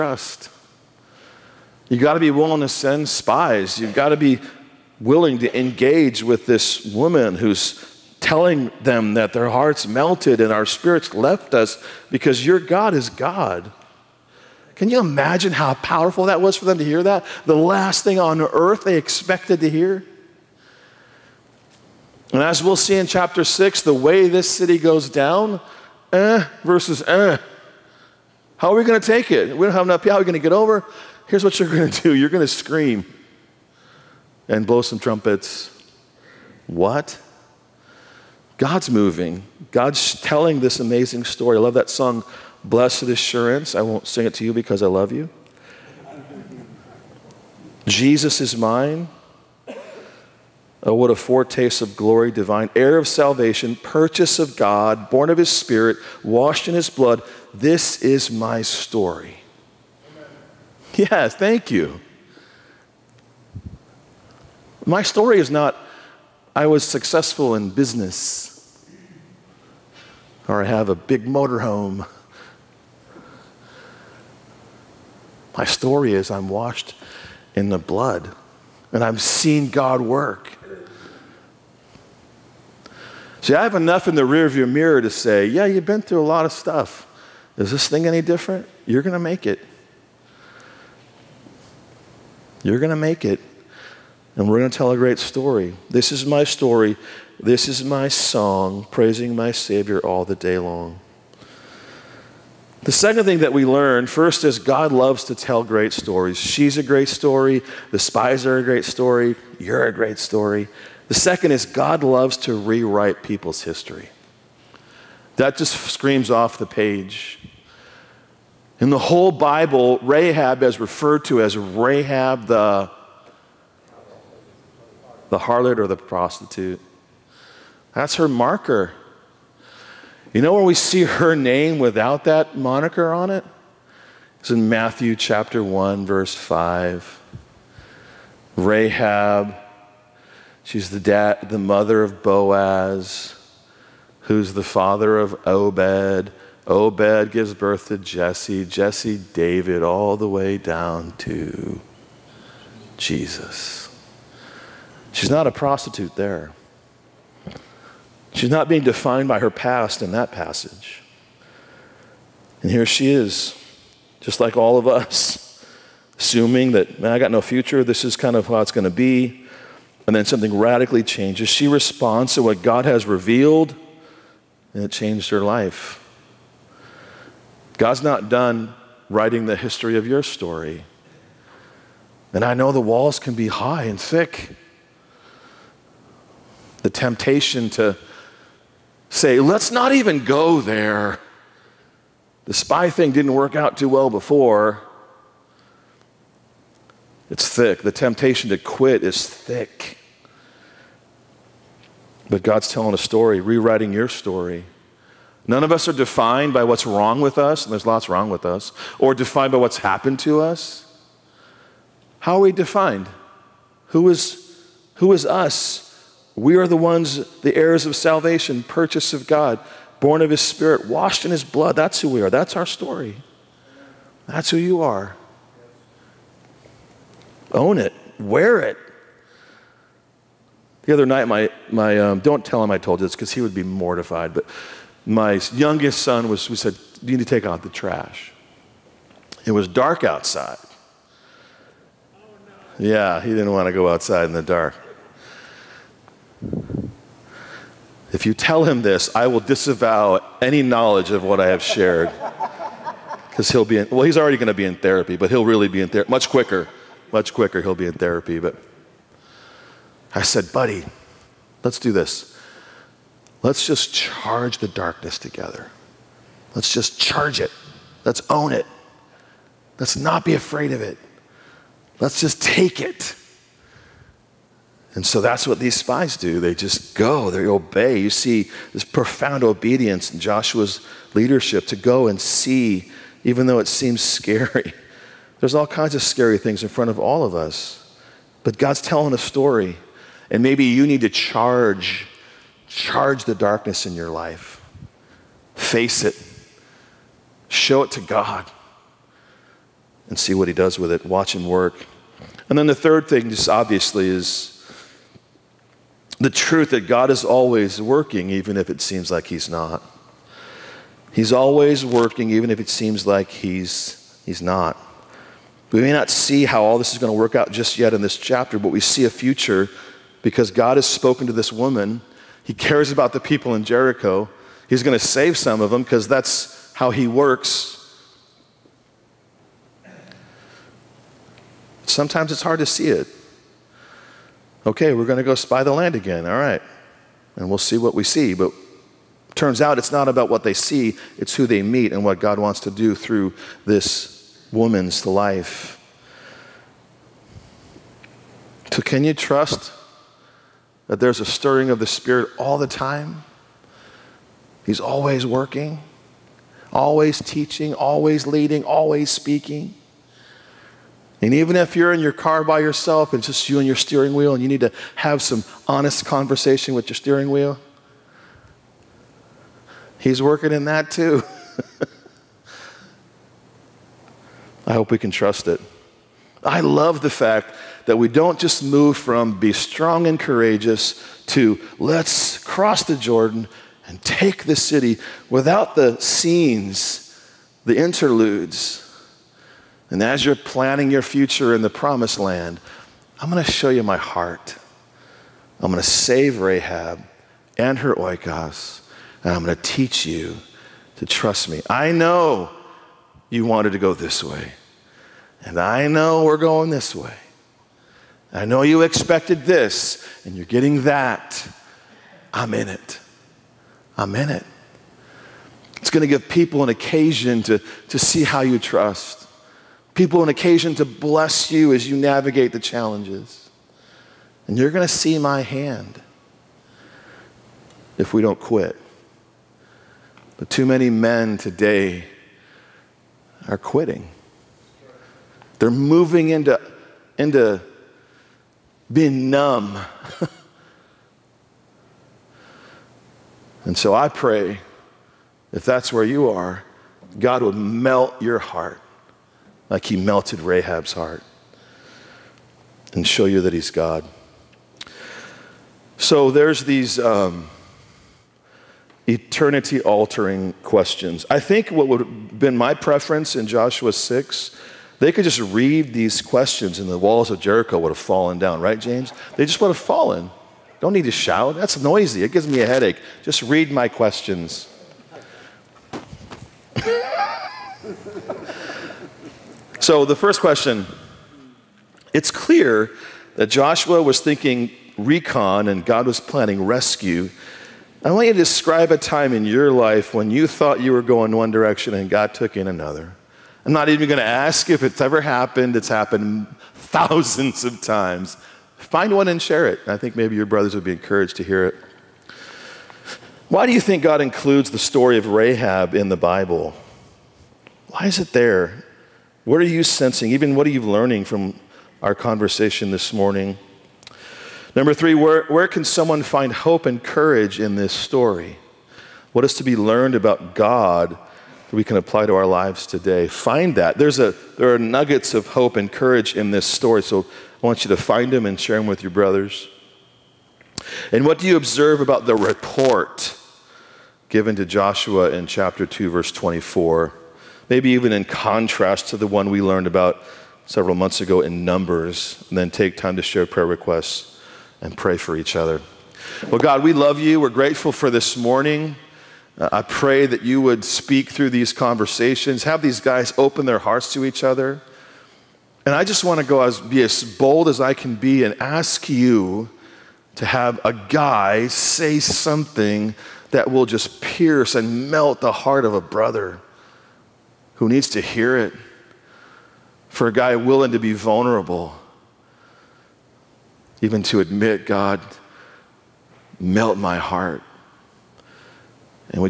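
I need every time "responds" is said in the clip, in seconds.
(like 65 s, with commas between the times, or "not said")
171 s.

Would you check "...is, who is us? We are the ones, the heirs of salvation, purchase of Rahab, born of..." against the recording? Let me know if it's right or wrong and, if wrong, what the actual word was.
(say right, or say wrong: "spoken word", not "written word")
wrong: "God", not "Rahab".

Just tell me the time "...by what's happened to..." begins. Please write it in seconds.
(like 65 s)
209 s.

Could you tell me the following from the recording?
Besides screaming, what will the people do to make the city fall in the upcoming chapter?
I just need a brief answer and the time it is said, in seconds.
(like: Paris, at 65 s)
blow some trumpets, at 34 s.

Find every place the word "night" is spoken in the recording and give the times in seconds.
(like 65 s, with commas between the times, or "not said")
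231 s.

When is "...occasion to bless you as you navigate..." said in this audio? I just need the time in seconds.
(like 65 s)
420 s.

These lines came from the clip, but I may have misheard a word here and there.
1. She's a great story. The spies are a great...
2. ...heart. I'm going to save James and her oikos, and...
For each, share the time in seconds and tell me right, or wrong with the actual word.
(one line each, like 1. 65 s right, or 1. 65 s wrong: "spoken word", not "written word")
1. 106 s right
2. 393 s wrong: "Rahab", not "James".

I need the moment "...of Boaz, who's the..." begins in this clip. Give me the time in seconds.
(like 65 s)
142 s.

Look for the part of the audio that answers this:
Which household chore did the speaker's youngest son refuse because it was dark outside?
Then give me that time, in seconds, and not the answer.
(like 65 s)
237 s.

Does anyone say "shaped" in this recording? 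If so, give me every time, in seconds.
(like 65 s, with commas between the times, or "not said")
not said.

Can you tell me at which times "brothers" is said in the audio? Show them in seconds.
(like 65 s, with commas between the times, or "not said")
500 s, 529 s, 566 s.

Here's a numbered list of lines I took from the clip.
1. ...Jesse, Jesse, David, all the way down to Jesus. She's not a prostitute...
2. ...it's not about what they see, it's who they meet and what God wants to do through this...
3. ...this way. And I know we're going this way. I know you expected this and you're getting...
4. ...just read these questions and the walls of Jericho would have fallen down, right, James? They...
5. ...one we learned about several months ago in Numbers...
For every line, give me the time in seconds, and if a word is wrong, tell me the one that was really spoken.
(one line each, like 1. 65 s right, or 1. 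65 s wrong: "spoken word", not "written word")
1. 147 s right
2. 339 s right
3. 403 s right
4. 465 s right
5. 539 s right.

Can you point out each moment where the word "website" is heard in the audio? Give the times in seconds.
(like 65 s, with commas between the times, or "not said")
not said.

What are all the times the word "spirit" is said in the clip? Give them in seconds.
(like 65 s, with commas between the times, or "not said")
10 s, 55 s, 220 s, 351 s.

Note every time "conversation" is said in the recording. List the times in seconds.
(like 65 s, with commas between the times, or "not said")
366 s, 512 s, 551 s.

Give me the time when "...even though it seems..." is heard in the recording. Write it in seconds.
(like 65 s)
283 s.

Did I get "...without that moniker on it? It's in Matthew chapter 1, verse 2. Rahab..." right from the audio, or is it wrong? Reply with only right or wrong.
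wrong.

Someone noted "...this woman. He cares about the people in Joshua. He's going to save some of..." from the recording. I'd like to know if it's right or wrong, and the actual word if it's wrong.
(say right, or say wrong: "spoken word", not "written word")
wrong: "Jericho", not "Joshua".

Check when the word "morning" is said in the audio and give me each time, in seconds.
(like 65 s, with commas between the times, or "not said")
513 s, 548 s.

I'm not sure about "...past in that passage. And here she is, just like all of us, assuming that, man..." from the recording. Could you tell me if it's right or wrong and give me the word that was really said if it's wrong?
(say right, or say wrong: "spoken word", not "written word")
right.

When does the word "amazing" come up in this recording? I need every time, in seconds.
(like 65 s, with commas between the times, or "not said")
40 s.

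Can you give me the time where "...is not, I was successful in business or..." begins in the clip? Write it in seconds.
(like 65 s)
65 s.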